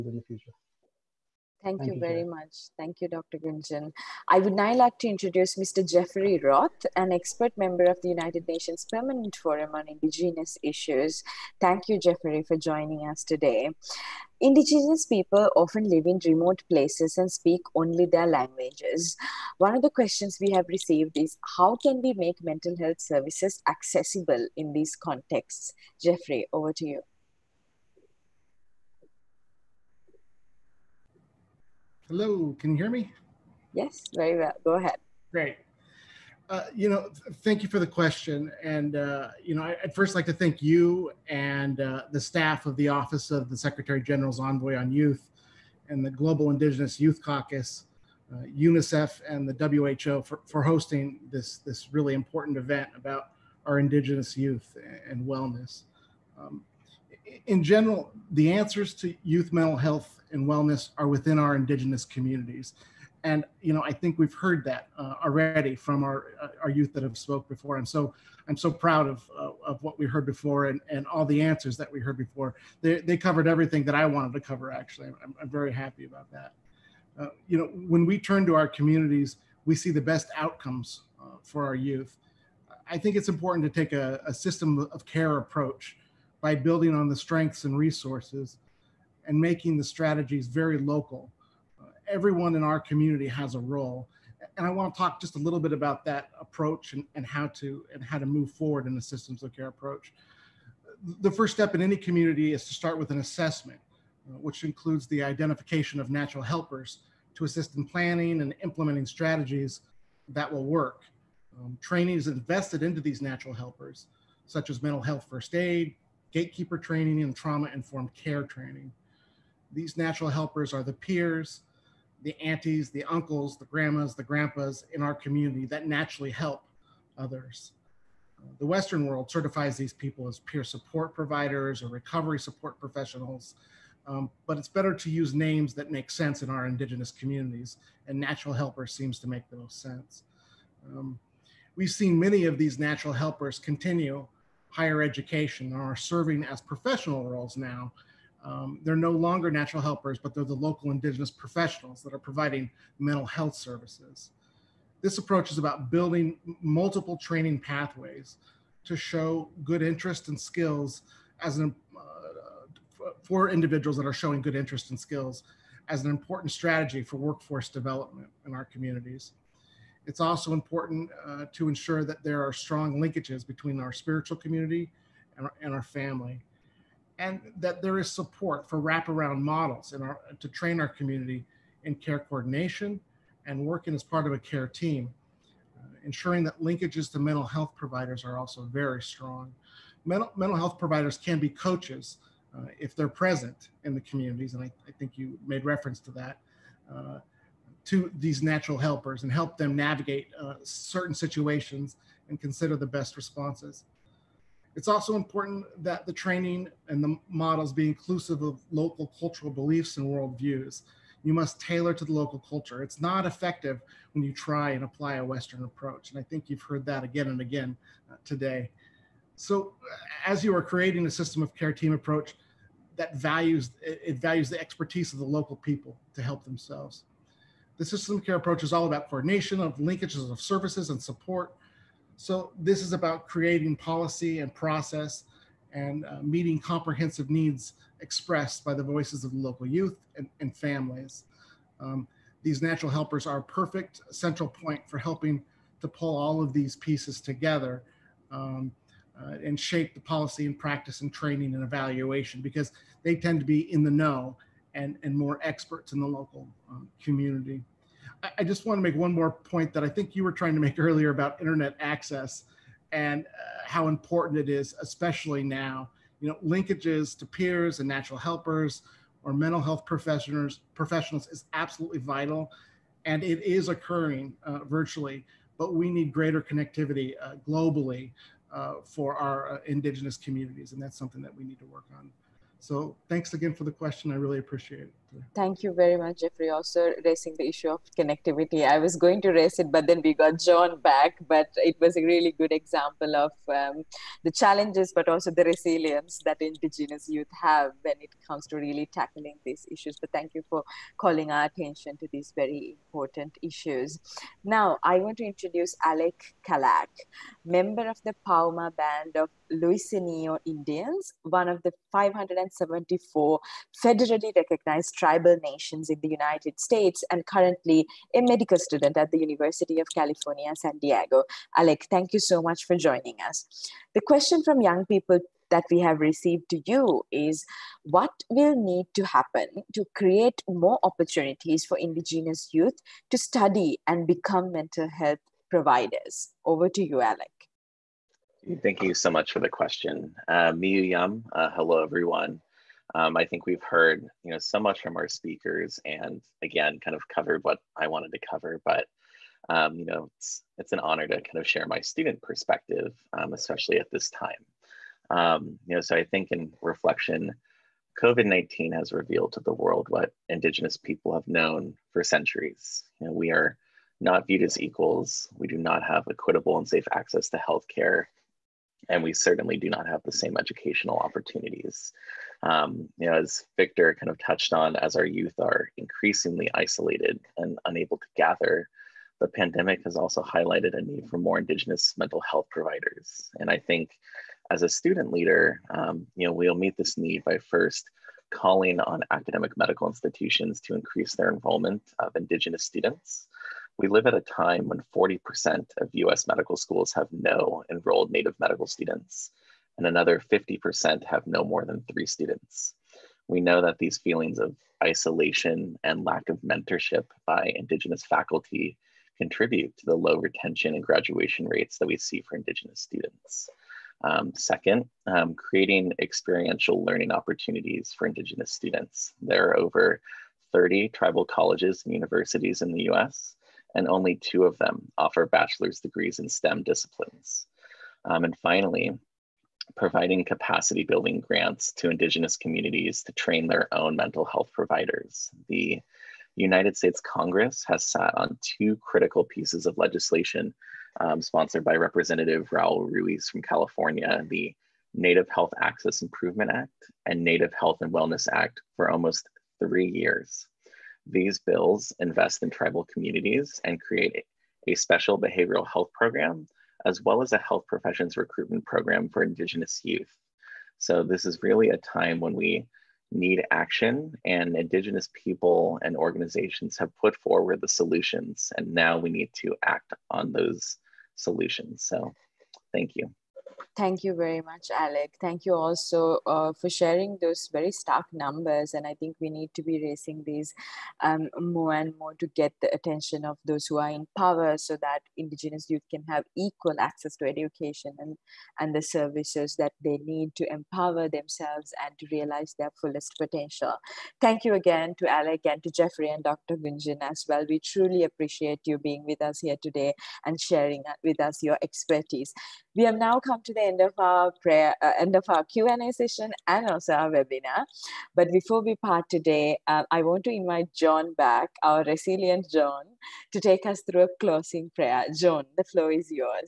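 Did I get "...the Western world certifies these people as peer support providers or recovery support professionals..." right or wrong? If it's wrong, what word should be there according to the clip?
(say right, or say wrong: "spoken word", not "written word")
right.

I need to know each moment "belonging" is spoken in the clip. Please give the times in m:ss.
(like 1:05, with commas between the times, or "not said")
not said.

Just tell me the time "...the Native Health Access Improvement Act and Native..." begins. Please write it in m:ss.
7:24.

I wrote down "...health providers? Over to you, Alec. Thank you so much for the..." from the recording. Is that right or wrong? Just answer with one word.
right.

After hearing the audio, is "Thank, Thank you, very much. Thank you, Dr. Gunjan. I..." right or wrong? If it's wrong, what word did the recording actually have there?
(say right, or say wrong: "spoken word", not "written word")
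right.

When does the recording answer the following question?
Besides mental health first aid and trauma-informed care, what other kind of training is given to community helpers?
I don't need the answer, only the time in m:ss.
1:56.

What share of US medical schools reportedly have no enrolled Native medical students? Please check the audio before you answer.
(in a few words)
40%.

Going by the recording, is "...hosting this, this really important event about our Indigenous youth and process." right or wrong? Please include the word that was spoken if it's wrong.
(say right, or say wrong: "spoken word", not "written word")
wrong: "wellness", not "process".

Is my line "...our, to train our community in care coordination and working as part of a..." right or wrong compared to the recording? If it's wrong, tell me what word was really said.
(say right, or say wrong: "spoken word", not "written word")
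right.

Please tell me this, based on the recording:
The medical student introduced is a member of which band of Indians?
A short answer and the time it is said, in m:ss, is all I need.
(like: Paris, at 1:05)
Pauma Band of Luiseño Indians, at 5:08.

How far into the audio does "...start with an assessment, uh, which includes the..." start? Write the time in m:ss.
1:42.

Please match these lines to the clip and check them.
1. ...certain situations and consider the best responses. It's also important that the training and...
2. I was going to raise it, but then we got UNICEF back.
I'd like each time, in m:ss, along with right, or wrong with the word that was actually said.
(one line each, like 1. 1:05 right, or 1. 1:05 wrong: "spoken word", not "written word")
1. 3:20 right
2. 4:48 wrong: "John", not "UNICEF".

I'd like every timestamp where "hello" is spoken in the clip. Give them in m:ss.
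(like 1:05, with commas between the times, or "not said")
0:32, 5:41.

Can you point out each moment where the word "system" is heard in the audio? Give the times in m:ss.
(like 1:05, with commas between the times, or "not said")
1:24, 1:39, 3:41, 3:47.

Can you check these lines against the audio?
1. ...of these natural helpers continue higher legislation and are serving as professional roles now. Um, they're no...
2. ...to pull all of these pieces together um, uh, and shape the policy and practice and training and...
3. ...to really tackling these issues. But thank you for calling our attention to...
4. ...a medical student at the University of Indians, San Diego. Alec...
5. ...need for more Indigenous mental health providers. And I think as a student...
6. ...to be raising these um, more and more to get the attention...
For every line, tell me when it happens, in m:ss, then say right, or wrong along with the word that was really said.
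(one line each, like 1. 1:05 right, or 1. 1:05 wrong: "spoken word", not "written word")
1. 2:22 wrong: "education", not "legislation"
2. 4:05 right
3. 4:58 right
4. 5:18 wrong: "California", not "Indians"
5. 6:20 right
6. 7:59 right.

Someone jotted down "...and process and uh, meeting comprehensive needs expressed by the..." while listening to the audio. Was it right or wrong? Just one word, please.
right.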